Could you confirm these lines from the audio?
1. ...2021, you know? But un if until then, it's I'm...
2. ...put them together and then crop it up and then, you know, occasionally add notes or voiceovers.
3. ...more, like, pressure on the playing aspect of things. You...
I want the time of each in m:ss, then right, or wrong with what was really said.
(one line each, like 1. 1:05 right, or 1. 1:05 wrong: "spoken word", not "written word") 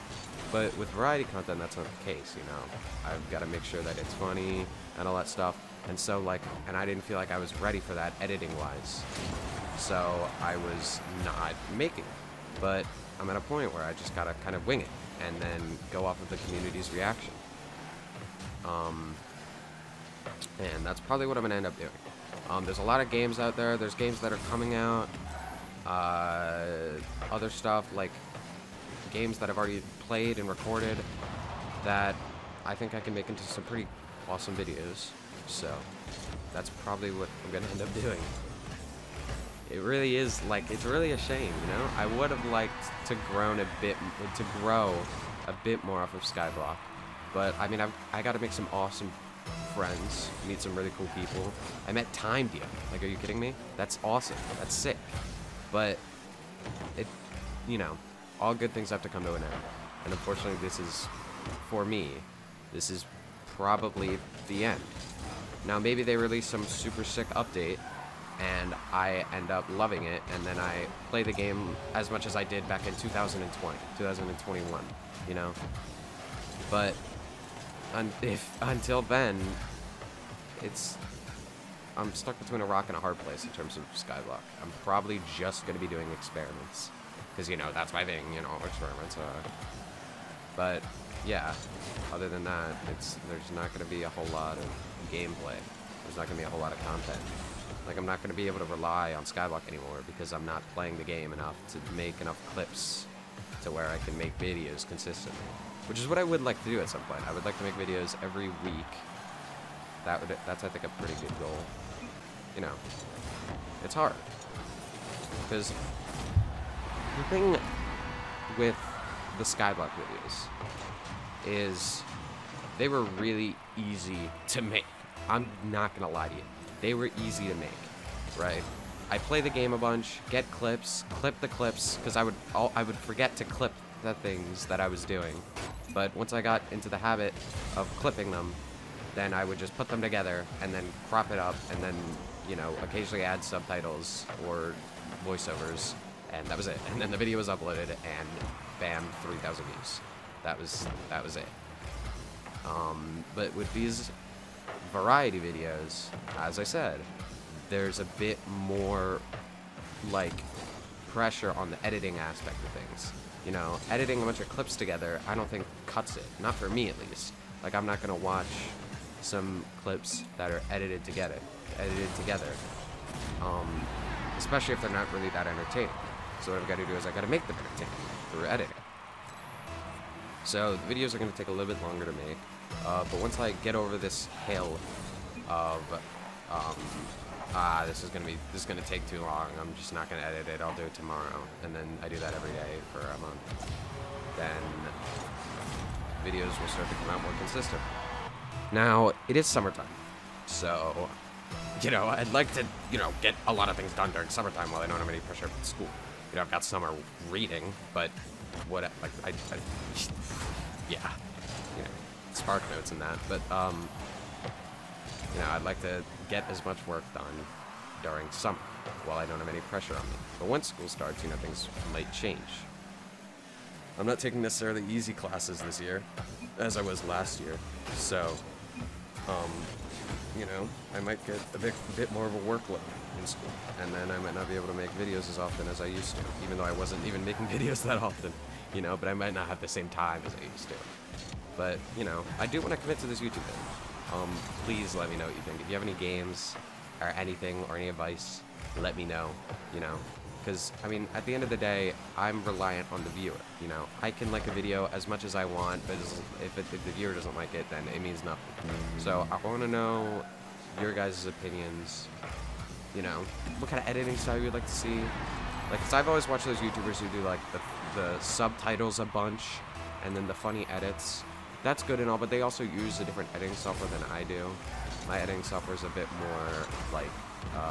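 1. 1:13 right
2. 2:19 wrong: "subtitles", not "notes"
3. 2:38 wrong: "editing", not "playing".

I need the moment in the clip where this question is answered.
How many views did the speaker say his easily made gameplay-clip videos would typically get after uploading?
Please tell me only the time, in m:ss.
2:29.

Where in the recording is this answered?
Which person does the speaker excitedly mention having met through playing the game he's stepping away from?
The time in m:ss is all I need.
0:52.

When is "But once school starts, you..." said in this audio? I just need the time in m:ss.
3:40.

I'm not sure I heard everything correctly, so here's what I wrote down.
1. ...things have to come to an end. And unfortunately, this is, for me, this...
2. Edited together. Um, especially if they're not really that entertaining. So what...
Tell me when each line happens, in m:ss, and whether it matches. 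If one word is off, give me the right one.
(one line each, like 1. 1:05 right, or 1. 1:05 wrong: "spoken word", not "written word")
1. 0:58 right
2. 2:51 right.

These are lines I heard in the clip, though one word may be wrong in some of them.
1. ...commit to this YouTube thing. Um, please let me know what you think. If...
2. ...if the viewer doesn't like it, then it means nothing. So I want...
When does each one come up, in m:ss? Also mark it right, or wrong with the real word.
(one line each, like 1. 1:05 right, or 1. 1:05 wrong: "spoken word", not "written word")
1. 4:02 right
2. 4:16 right.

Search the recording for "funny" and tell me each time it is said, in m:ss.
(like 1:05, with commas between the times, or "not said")
0:04, 4:30.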